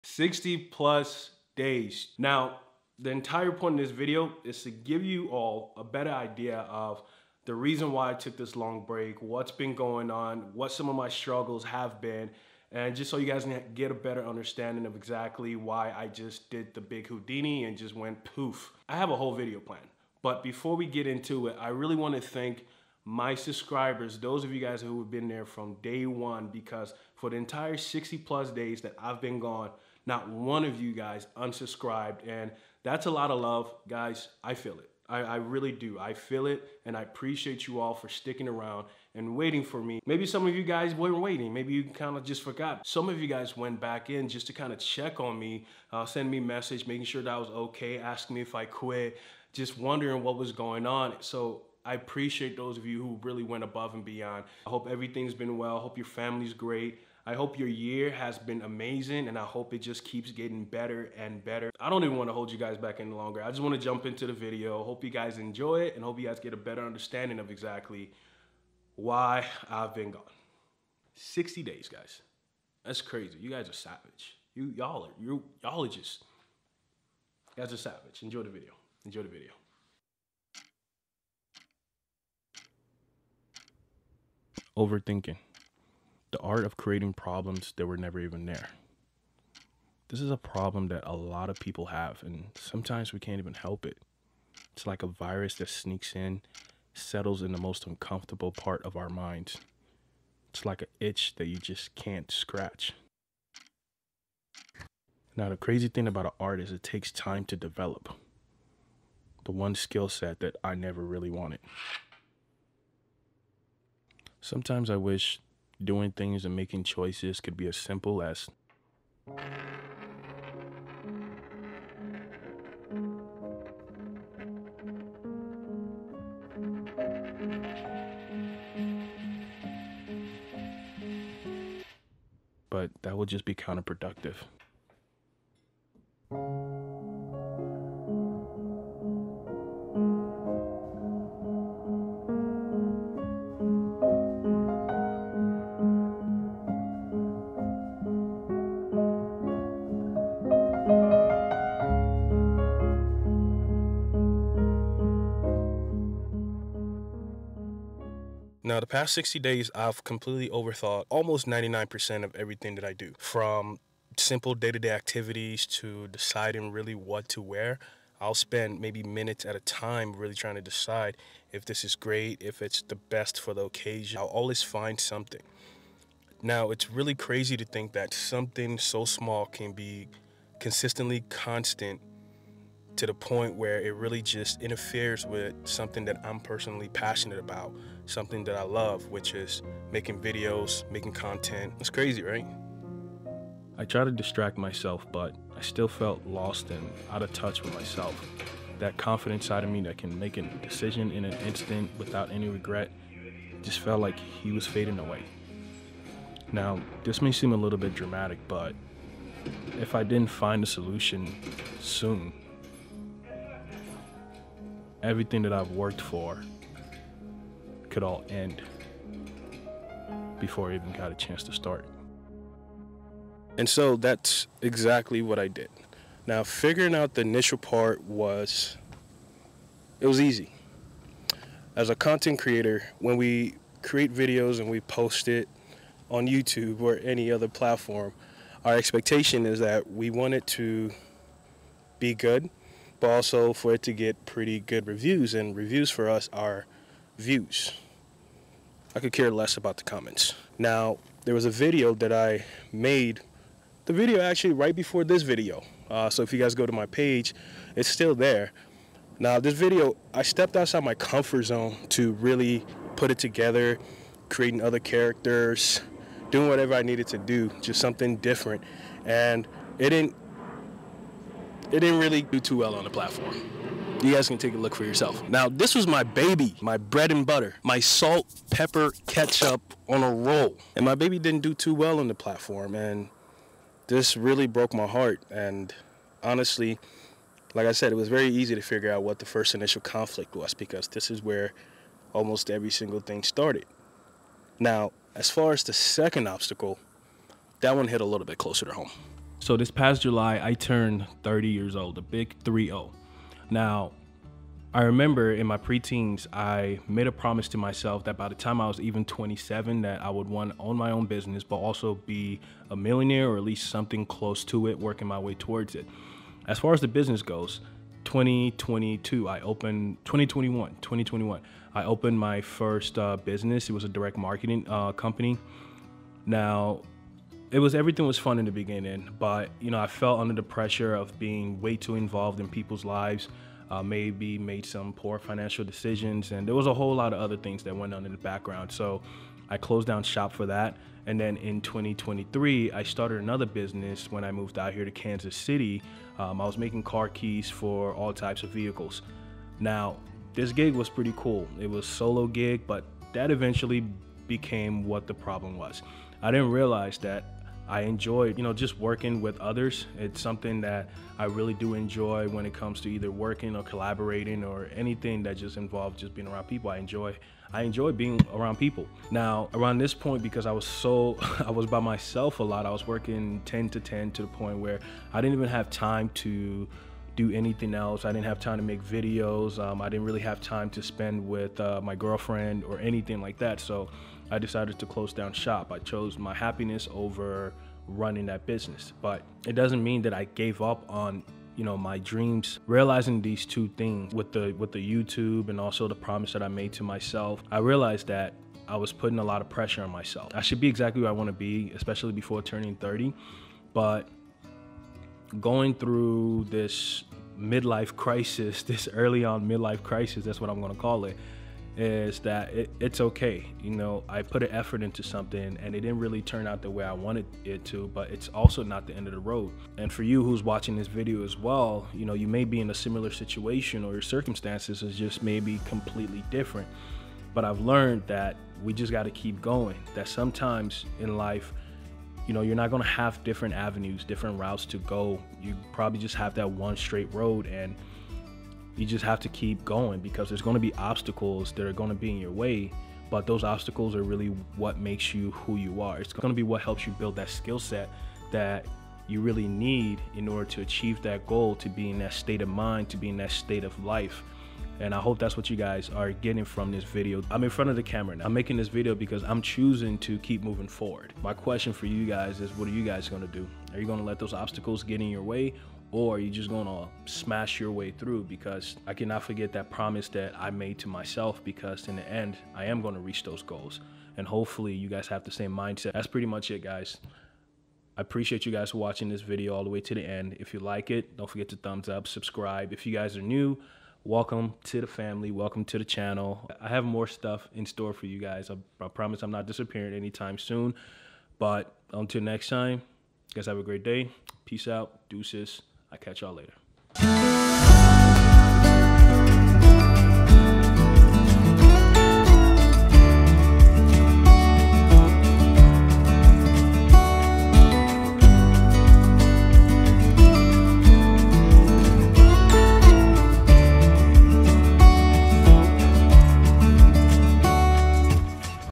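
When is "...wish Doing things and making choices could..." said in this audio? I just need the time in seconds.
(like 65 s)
114 s.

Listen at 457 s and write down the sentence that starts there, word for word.
I'm in front of the camera now.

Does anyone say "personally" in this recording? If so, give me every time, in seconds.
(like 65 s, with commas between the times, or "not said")
186 s.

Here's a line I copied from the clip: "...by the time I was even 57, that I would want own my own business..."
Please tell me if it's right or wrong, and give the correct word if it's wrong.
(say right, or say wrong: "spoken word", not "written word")
wrong: "27", not "57".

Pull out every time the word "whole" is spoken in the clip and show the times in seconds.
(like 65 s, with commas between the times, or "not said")
19 s, 336 s.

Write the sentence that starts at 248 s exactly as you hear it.
I could care less about the comments.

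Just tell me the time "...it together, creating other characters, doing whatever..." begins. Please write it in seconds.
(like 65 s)
263 s.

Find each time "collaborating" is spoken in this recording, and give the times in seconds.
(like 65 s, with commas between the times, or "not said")
363 s.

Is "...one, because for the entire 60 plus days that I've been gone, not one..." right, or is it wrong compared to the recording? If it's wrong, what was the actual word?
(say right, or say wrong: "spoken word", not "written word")
right.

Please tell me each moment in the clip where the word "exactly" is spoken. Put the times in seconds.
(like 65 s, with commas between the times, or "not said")
14 s, 67 s, 224 s, 400 s.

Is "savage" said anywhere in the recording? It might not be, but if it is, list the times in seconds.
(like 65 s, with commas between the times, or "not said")
73 s, 77 s.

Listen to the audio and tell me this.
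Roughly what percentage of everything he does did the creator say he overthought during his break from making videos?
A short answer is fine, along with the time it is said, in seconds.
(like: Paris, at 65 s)
99%, at 161 s.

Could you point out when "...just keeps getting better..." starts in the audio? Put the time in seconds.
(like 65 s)
59 s.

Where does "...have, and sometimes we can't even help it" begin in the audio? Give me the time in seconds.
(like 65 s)
91 s.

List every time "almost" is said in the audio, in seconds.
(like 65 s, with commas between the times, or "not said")
161 s, 292 s.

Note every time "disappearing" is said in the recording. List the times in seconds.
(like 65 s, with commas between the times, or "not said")
489 s.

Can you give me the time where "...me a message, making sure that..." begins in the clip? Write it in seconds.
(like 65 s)
46 s.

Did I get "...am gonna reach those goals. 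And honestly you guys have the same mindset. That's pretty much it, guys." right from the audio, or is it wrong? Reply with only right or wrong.
wrong.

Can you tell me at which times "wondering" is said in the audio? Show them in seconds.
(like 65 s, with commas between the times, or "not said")
49 s.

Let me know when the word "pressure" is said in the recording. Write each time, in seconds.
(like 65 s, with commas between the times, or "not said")
330 s, 399 s.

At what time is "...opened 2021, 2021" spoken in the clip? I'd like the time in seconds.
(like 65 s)
319 s.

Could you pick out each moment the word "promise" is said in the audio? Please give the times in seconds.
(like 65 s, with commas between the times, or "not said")
307 s, 395 s, 469 s, 488 s.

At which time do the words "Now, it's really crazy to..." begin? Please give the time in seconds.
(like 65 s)
176 s.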